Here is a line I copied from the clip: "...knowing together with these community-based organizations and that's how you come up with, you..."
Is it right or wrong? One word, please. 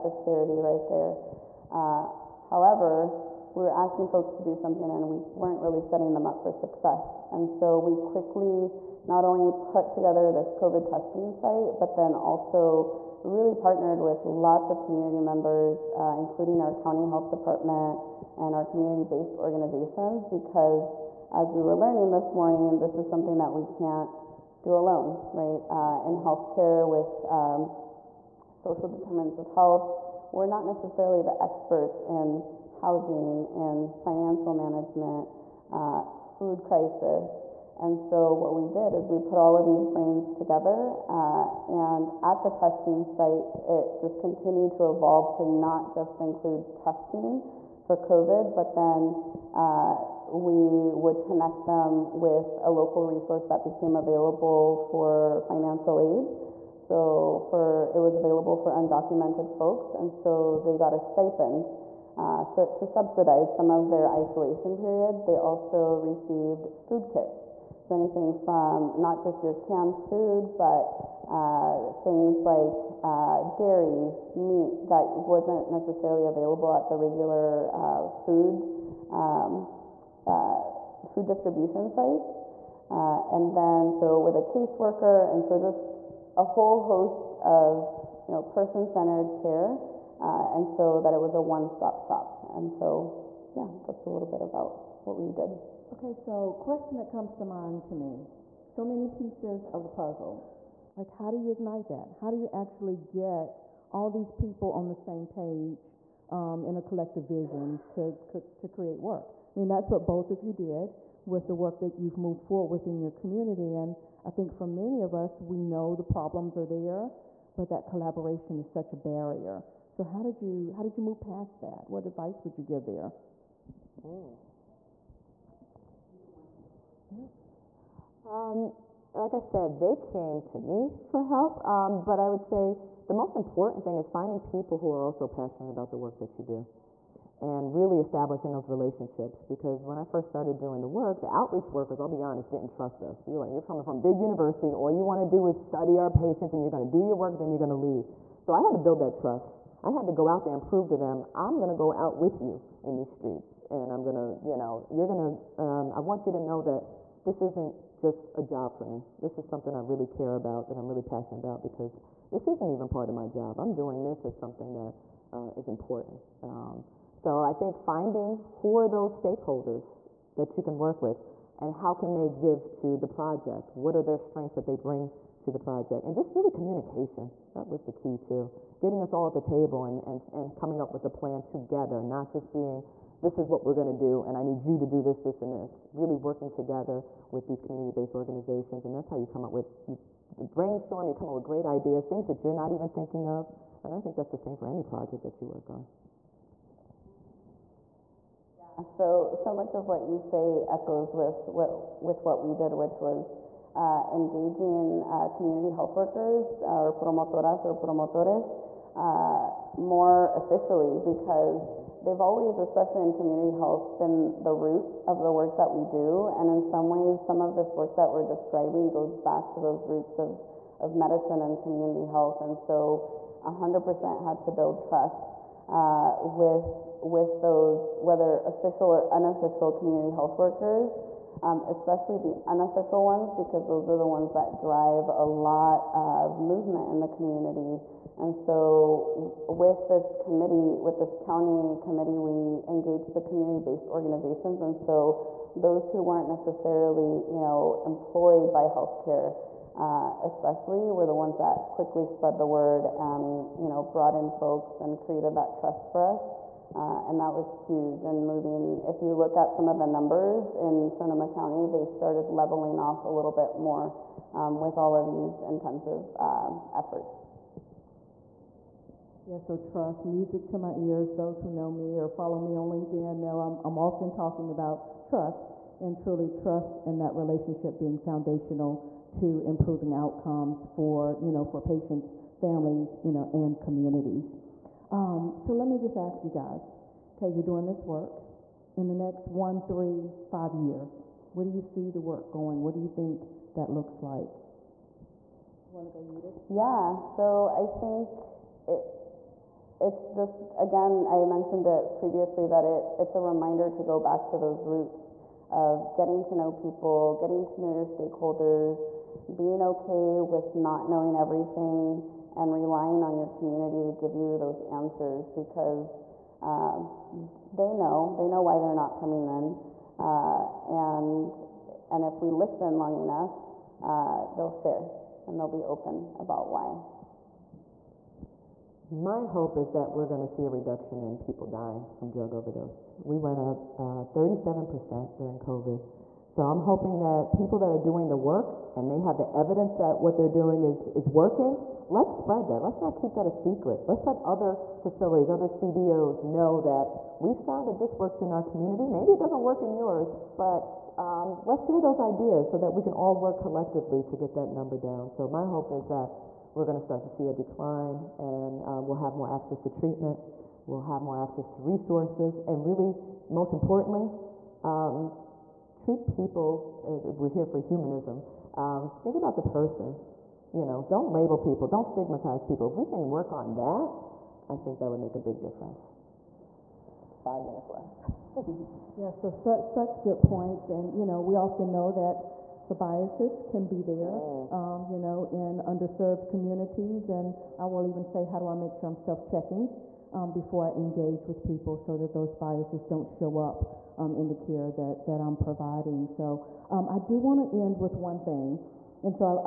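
wrong.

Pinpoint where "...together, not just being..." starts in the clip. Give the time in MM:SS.
03:01.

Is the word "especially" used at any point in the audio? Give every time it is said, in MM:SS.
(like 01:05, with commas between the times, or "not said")
03:32, 03:51, 04:10.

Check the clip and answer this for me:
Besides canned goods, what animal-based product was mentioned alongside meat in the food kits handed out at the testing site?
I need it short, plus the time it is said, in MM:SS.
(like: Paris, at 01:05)
dairy, at 01:13.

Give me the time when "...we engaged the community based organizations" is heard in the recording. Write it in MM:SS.
04:02.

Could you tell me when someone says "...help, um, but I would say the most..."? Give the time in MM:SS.
02:11.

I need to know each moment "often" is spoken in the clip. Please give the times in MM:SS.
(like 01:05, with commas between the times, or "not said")
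04:33, 06:21.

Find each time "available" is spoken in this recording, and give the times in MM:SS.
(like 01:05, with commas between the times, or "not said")
00:53, 00:58, 01:16.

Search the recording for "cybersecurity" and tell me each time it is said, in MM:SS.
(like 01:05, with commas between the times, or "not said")
not said.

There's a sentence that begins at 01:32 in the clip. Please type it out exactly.
And so, yeah, that's a little bit about what we did.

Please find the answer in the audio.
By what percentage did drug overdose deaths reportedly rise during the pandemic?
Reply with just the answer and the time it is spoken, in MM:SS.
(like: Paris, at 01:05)
37%, at 05:33.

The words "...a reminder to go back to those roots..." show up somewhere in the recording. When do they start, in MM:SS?
05:03.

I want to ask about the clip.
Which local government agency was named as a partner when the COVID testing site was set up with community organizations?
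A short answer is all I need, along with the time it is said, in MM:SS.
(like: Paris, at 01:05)
county health department, at 00:16.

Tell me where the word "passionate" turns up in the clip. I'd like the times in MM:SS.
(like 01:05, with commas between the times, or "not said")
02:15, 02:41.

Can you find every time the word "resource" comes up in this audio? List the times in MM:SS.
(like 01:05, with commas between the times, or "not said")
00:53, 06:01.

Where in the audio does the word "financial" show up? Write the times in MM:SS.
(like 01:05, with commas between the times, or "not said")
00:33, 00:55.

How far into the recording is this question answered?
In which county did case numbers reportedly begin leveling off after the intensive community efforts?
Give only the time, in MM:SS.
04:20.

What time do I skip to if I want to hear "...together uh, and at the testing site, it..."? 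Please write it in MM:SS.
00:40.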